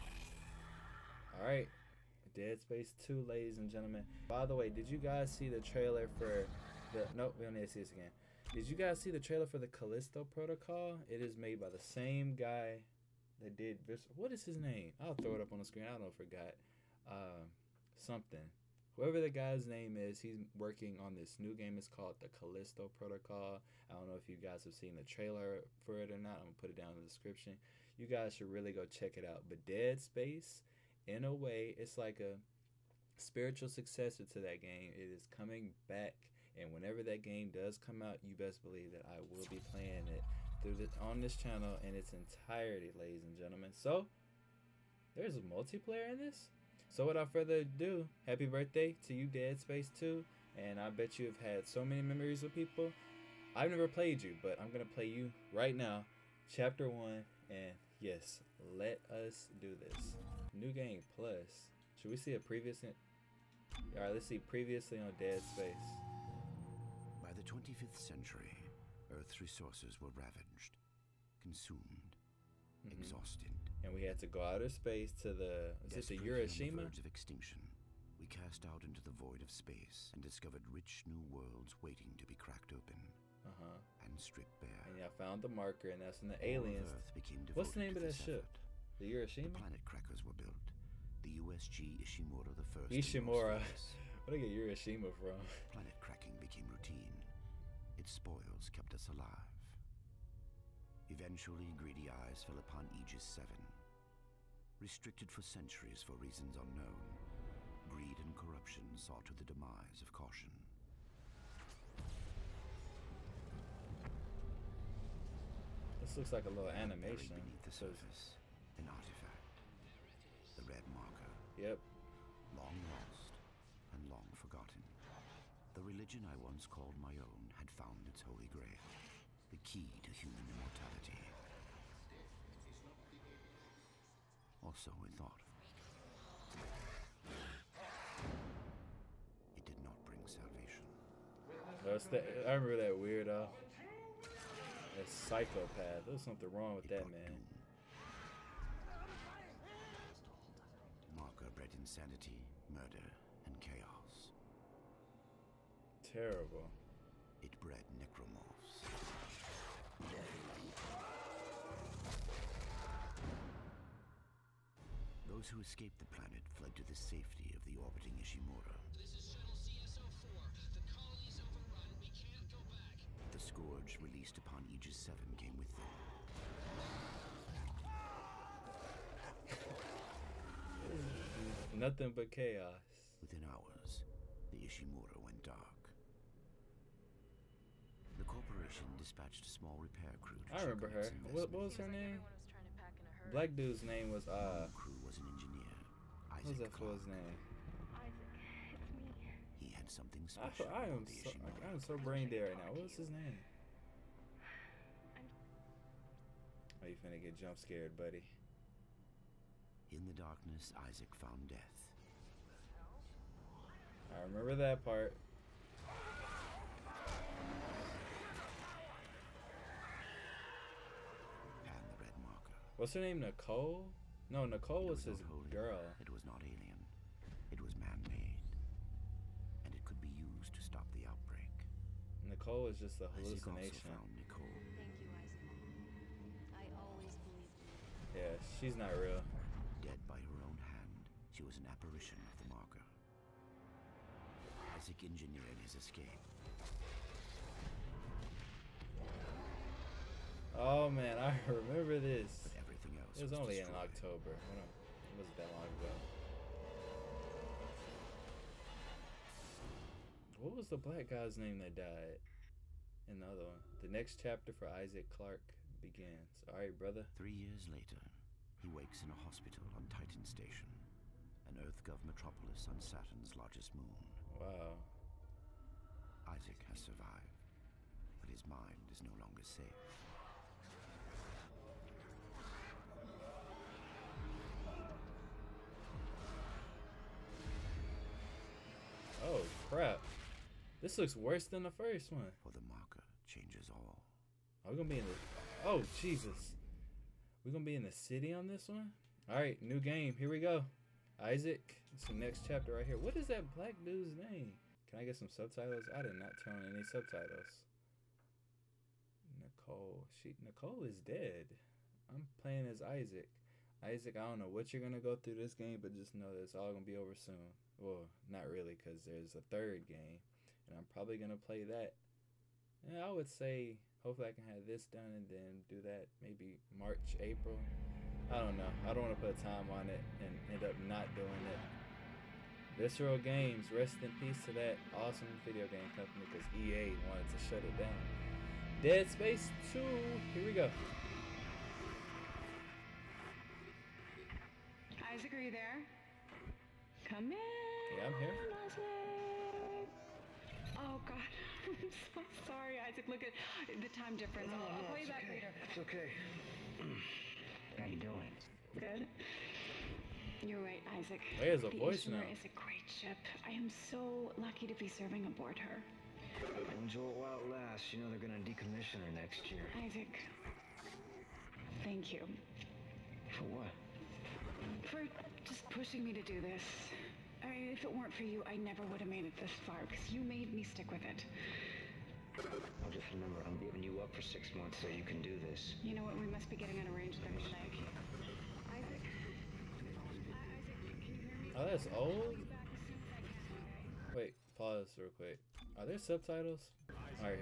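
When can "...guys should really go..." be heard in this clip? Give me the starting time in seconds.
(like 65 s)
28 s.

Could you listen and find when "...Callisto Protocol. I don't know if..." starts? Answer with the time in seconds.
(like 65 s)
22 s.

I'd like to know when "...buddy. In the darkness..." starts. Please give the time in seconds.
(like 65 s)
207 s.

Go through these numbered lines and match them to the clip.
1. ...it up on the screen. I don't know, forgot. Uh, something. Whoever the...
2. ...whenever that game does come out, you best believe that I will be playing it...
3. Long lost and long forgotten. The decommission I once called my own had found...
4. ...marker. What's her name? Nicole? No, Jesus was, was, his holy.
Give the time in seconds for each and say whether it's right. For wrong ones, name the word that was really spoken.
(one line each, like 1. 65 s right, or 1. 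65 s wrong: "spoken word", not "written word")
1. 15 s right
2. 36 s right
3. 122 s wrong: "religion", not "decommission"
4. 222 s wrong: "Nicole", not "Jesus".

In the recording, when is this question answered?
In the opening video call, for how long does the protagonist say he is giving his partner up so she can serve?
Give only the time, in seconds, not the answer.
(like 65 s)
384 s.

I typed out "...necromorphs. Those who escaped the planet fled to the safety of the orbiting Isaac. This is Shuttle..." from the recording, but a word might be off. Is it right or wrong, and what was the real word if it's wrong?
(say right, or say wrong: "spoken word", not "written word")
wrong: "Ishimura", not "Isaac".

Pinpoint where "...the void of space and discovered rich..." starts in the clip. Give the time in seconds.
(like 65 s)
79 s.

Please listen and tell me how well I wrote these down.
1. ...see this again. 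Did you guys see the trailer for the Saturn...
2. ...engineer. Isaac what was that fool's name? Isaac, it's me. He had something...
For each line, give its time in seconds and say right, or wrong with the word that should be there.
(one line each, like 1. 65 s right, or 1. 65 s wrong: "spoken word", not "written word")
1. 7 s wrong: "Callisto", not "Saturn"
2. 195 s right.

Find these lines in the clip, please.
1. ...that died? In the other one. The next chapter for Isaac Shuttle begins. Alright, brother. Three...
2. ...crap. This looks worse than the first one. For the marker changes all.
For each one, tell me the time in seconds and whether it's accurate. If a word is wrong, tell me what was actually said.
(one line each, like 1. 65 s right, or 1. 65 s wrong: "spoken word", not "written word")
1. 261 s wrong: "Clarke", not "Shuttle"
2. 289 s right.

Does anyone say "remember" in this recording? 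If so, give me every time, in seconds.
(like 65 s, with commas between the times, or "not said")
142 s, 190 s, 214 s, 251 s, 383 s.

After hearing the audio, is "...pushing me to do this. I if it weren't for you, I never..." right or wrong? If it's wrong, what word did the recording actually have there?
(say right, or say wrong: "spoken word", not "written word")
right.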